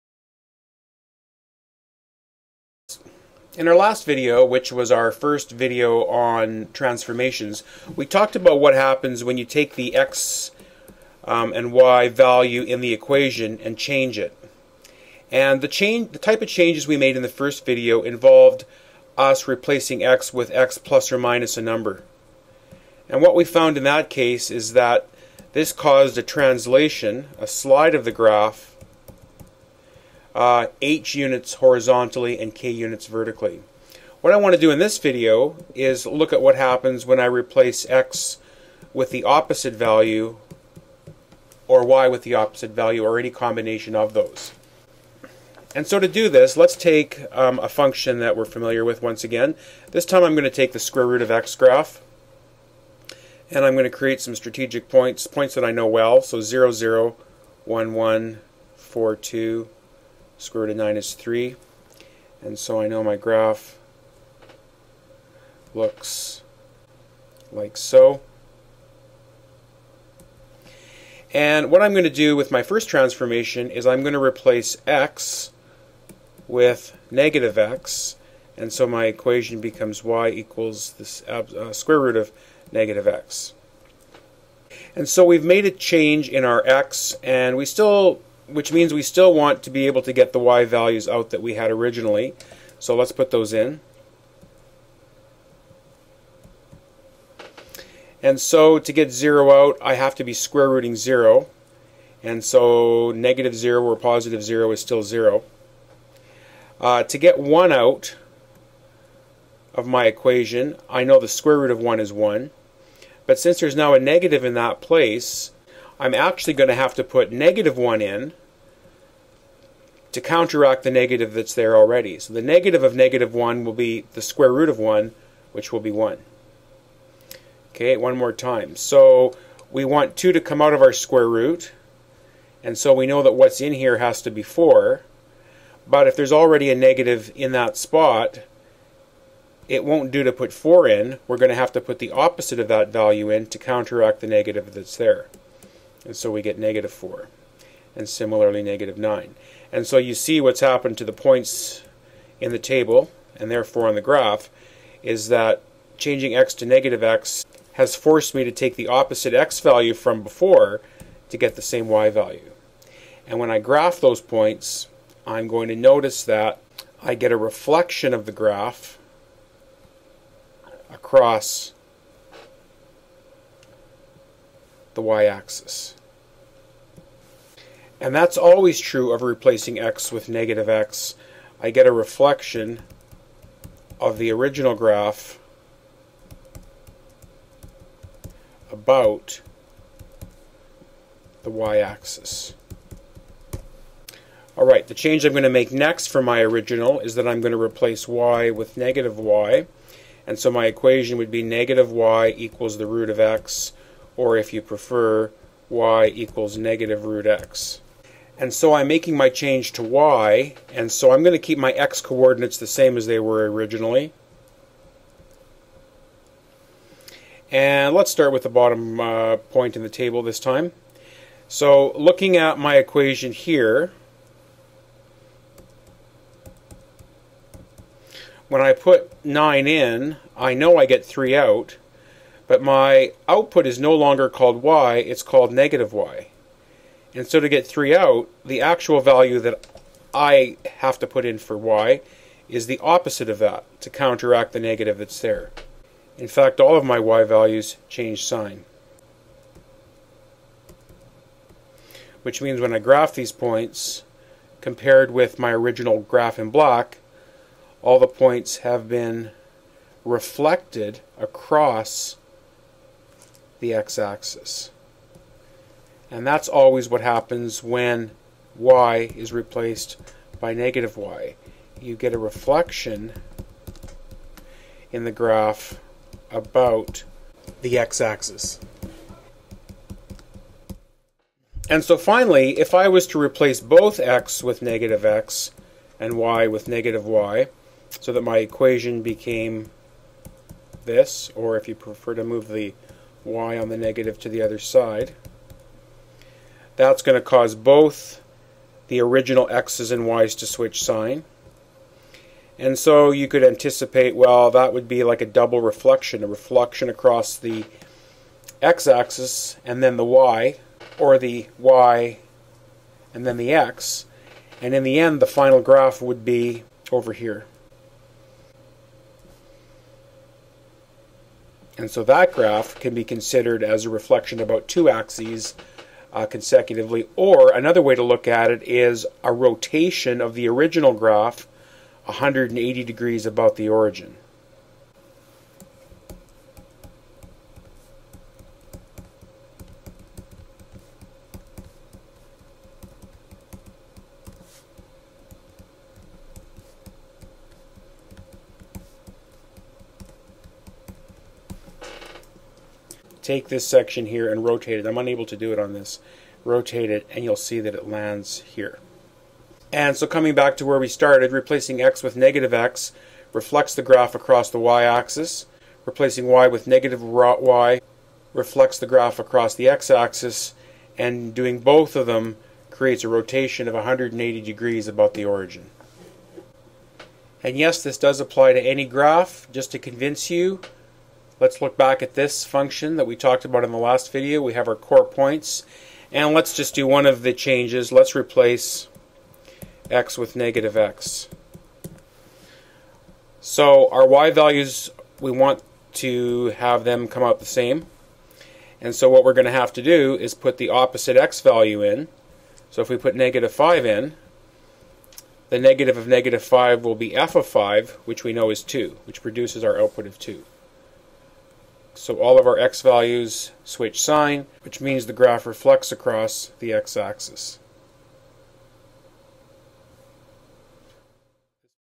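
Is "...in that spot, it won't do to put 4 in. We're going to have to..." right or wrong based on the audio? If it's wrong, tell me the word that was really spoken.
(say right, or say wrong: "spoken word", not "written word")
right.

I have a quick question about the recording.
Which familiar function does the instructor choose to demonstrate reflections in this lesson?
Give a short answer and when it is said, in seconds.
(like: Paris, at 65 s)
square root of x, at 50 s.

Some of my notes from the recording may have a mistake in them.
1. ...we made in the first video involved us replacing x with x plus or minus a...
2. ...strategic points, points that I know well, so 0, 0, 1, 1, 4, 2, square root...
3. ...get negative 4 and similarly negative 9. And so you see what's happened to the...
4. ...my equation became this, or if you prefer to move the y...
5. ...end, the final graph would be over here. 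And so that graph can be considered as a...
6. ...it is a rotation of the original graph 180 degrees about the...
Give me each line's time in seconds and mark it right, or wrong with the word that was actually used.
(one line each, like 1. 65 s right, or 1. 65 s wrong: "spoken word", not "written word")
1. 16 s right
2. 54 s right
3. 146 s right
4. 288 s right
5. 314 s right
6. 328 s right.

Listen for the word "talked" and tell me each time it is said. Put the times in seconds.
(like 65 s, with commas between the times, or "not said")
8 s, 383 s.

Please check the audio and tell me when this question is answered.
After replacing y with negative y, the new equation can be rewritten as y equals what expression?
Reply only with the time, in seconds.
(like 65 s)
206 s.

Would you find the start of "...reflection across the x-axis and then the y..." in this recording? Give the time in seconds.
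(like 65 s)
306 s.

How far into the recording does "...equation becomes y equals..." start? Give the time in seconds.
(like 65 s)
79 s.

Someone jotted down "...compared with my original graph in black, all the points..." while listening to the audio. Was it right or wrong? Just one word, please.
right.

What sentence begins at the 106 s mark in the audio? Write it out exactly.
Uh, to get 1 out of my equation, I know the square root of 1 is 1.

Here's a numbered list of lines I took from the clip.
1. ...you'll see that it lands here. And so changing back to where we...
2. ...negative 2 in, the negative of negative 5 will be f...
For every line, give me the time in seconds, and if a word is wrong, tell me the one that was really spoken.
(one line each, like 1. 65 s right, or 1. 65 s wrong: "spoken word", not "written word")
1. 357 s wrong: "coming", not "changing"
2. 403 s wrong: "5", not "2".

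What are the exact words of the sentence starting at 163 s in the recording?
And when I graph those points, I'm going to notice that I get a reflection of the graph across the y-axis.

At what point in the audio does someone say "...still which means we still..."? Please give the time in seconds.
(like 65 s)
87 s.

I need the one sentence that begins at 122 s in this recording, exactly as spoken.
So the negative of negative 1 will be the square root of 1, which will be 1.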